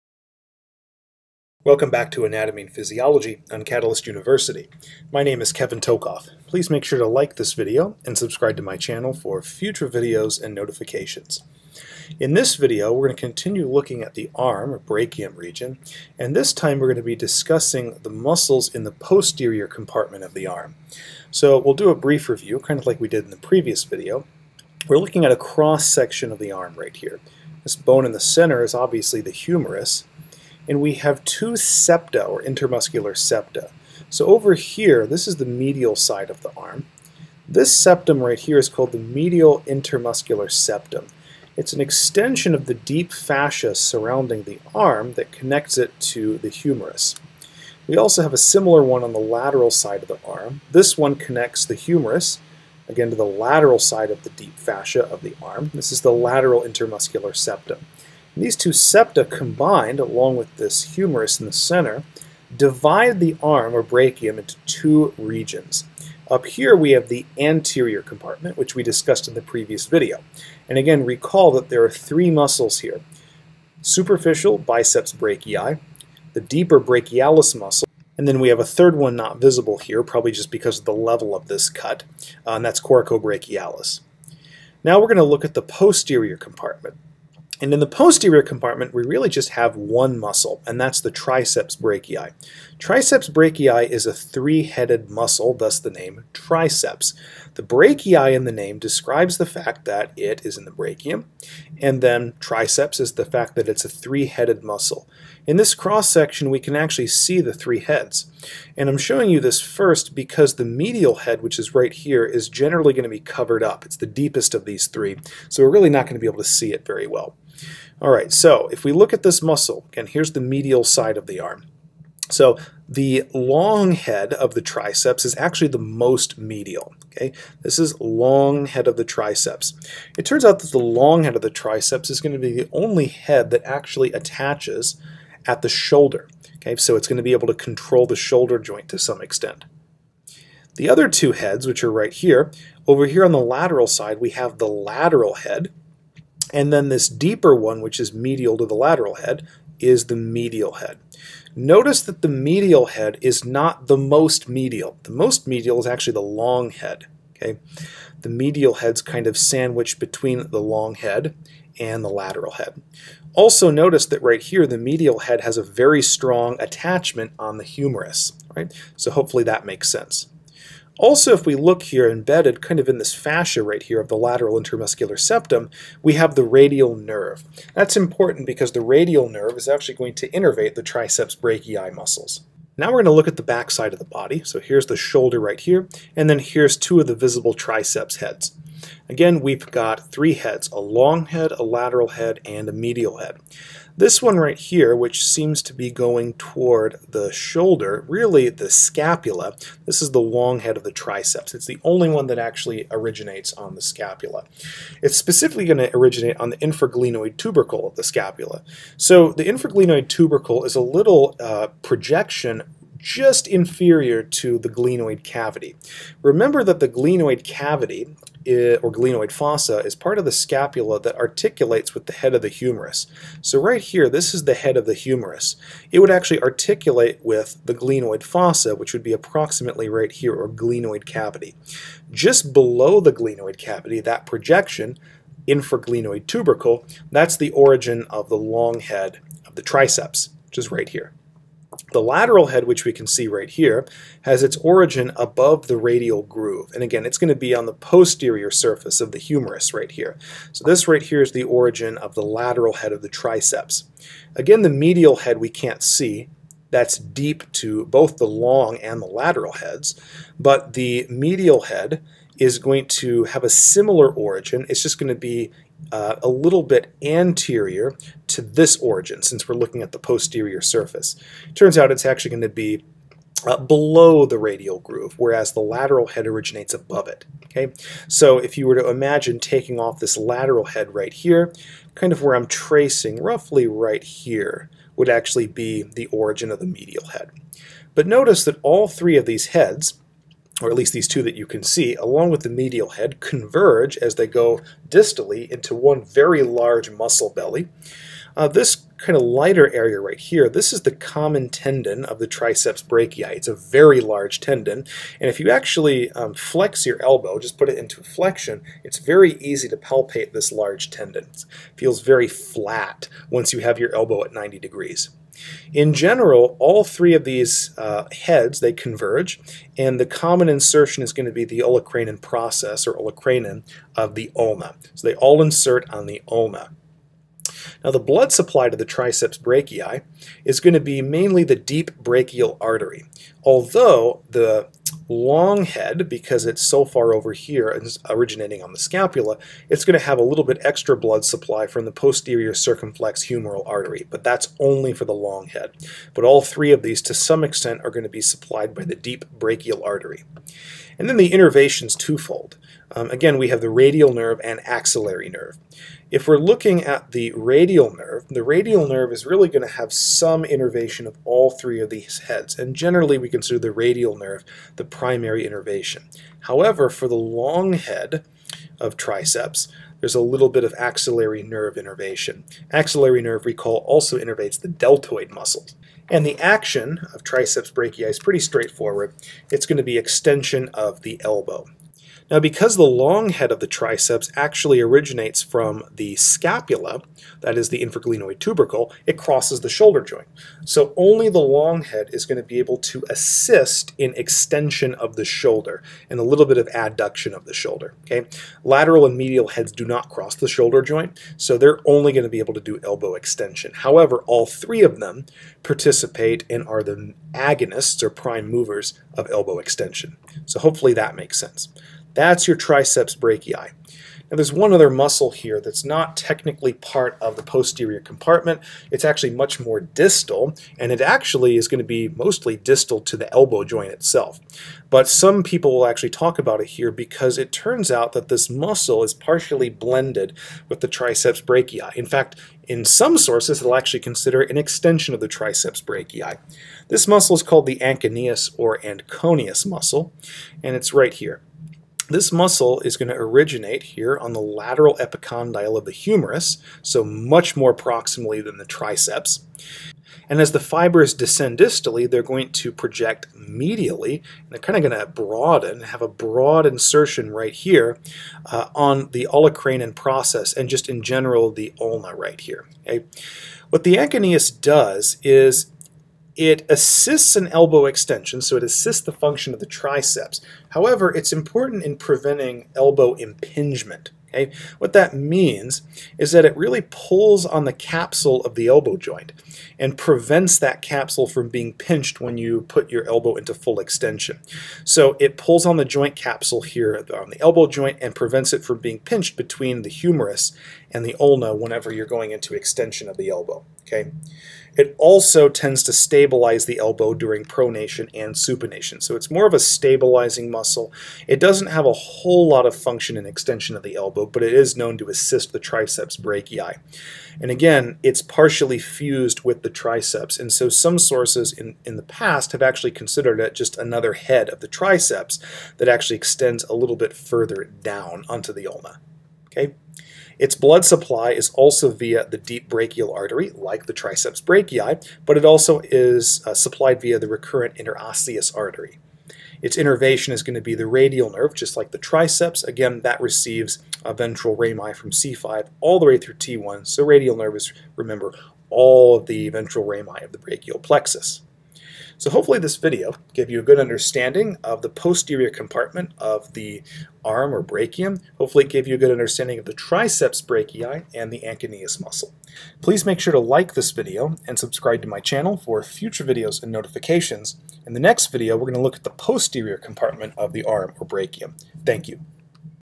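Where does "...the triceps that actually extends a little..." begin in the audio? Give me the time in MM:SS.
08:34.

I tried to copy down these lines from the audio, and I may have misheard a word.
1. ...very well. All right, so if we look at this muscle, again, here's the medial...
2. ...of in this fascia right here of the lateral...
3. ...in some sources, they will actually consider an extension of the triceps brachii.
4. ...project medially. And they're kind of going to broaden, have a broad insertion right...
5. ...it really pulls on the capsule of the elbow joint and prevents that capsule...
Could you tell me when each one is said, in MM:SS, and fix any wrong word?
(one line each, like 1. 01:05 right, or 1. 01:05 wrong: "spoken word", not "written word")
1. 01:56 right
2. 02:52 right
3. 07:12 right
4. 07:32 right
5. 07:56 right.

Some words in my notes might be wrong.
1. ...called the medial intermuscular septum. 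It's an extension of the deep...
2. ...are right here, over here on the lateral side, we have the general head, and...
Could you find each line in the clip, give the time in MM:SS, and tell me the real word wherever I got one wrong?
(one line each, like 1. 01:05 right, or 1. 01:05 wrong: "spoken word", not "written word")
1. 00:38 right
2. 02:21 wrong: "lateral", not "general".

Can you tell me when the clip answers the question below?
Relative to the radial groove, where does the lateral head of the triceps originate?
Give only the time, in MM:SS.
04:05.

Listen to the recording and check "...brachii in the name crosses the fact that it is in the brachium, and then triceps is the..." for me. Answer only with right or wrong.
wrong.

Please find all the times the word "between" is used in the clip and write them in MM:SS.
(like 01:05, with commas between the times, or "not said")
02:39, 08:09.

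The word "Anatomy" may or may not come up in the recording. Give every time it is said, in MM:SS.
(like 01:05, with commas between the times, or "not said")
00:02.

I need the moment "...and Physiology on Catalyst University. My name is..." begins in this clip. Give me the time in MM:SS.
00:02.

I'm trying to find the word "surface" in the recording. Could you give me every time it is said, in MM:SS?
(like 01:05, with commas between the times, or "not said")
04:08, 04:30.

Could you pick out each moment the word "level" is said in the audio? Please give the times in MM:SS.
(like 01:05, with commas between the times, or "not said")
01:20.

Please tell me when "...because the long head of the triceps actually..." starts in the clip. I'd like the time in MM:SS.
06:22.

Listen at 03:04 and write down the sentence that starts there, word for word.
So here's the shoulder right here, and then here's two of the visible triceps heads.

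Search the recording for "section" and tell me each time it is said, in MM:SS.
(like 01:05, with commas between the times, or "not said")
00:25, 01:46.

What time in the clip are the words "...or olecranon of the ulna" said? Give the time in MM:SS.
05:22.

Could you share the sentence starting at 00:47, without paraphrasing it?
We also have a similar one on the lateral side of the arm.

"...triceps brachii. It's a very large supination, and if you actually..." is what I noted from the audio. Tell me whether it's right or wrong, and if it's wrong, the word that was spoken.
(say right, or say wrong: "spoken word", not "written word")
wrong: "tendon", not "supination".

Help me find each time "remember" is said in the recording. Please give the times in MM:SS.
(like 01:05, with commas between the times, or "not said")
03:36, 08:57.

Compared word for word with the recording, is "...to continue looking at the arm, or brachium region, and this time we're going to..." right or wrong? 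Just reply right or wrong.
right.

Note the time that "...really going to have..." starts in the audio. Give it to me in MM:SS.
05:59.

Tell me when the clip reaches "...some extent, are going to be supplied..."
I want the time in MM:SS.
05:47.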